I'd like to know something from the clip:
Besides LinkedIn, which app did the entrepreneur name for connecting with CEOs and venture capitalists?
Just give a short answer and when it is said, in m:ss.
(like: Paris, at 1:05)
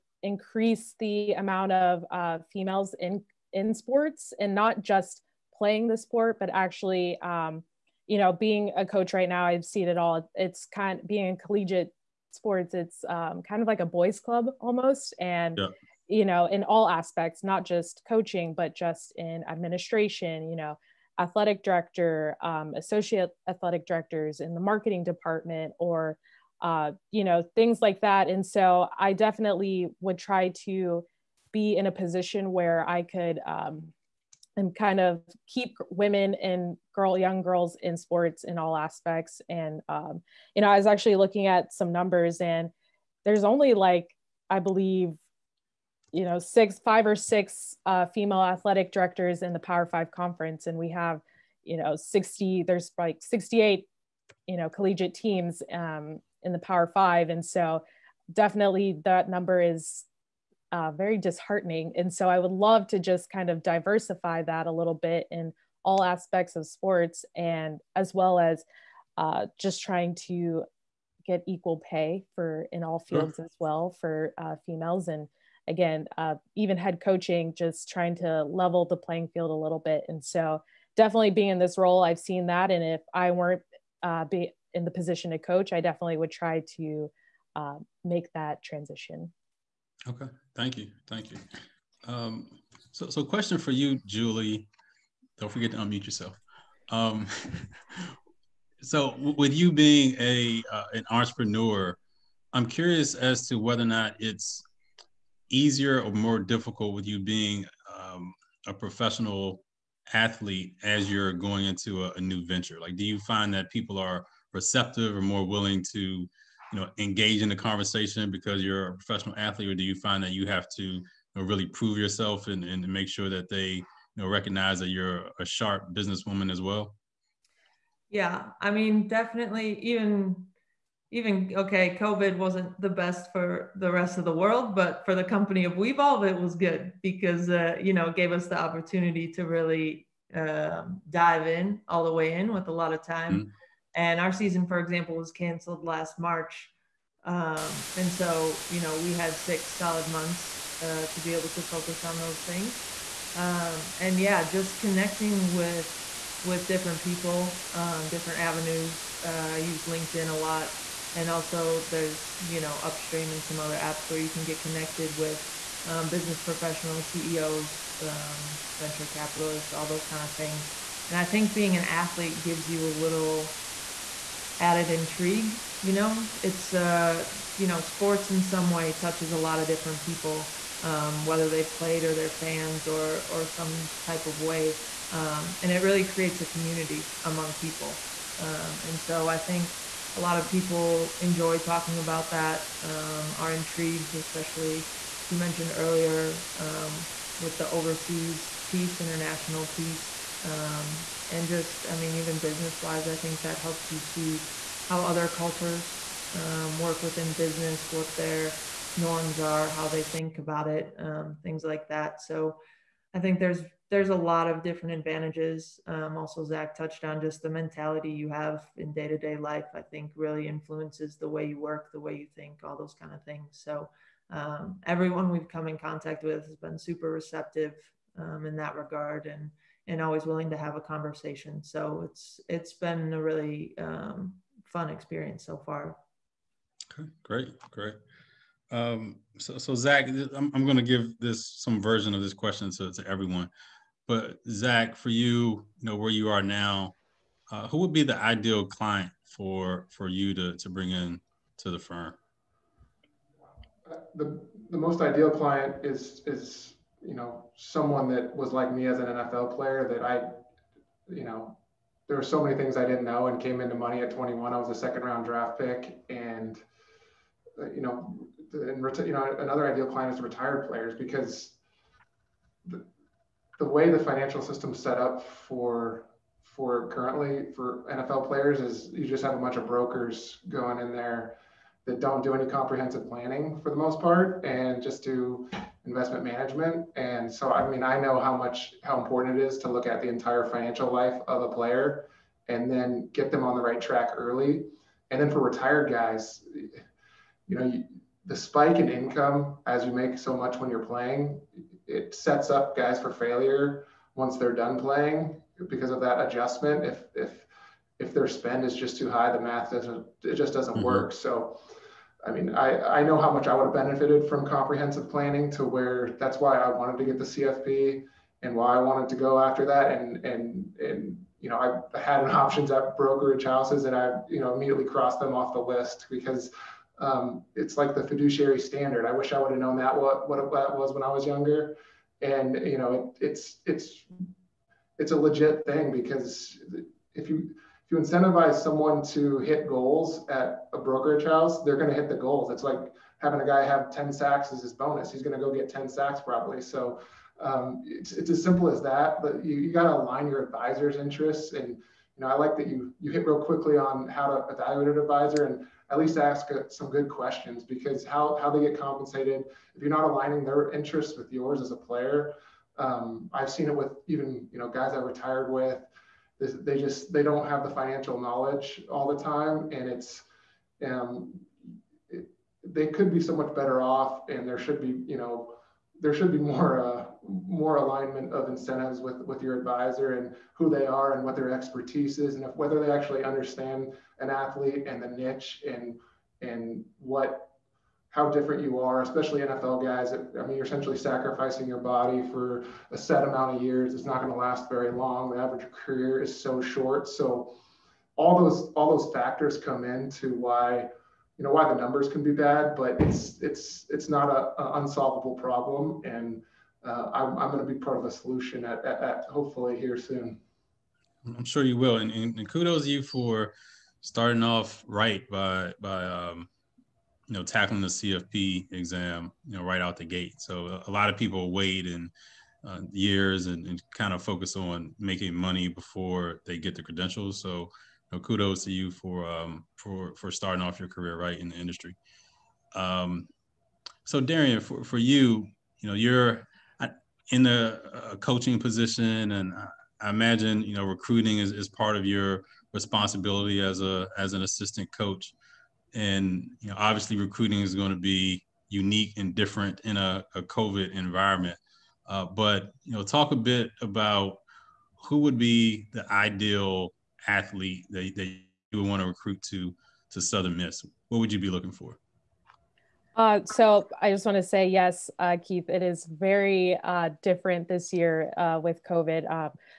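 Upstream, at 2:42.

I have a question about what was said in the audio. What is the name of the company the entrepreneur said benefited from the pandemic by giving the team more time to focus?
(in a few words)
Wevolv.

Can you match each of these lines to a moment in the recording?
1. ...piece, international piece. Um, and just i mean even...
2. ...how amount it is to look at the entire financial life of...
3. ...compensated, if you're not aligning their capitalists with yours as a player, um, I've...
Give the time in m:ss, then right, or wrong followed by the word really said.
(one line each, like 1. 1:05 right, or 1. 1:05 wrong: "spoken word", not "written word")
1. 3:18 right
2. 4:48 wrong: "important", not "amount"
3. 5:58 wrong: "interests", not "capitalists".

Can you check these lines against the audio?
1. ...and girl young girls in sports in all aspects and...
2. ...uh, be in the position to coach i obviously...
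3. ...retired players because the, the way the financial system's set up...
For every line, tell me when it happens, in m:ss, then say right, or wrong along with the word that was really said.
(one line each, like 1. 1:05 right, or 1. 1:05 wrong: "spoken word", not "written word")
1. 0:36 right
2. 1:24 wrong: "definitely", not "obviously"
3. 4:30 right.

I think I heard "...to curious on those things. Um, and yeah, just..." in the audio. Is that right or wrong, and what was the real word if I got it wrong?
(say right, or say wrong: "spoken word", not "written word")
wrong: "focus", not "curious".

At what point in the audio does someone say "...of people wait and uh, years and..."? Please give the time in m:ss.
7:01.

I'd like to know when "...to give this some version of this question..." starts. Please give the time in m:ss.
4:00.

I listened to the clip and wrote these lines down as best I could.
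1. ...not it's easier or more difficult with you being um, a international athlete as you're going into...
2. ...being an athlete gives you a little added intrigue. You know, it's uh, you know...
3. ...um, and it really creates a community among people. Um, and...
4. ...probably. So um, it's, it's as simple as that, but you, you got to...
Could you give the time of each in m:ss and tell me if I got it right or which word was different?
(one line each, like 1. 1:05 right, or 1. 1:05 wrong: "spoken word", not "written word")
1. 1:43 wrong: "professional", not "international"
2. 2:51 right
3. 3:05 right
4. 5:46 right.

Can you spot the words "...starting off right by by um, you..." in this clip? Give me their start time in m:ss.
6:54.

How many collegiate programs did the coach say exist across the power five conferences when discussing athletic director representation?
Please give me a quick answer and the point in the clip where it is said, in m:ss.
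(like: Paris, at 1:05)
68, at 0:52.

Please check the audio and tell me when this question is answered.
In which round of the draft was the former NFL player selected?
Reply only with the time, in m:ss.
4:24.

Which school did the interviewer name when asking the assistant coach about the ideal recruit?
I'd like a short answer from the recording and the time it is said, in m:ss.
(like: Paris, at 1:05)
Southern Miss, at 7:40.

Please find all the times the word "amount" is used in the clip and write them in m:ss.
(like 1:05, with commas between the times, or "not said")
0:01, 6:33.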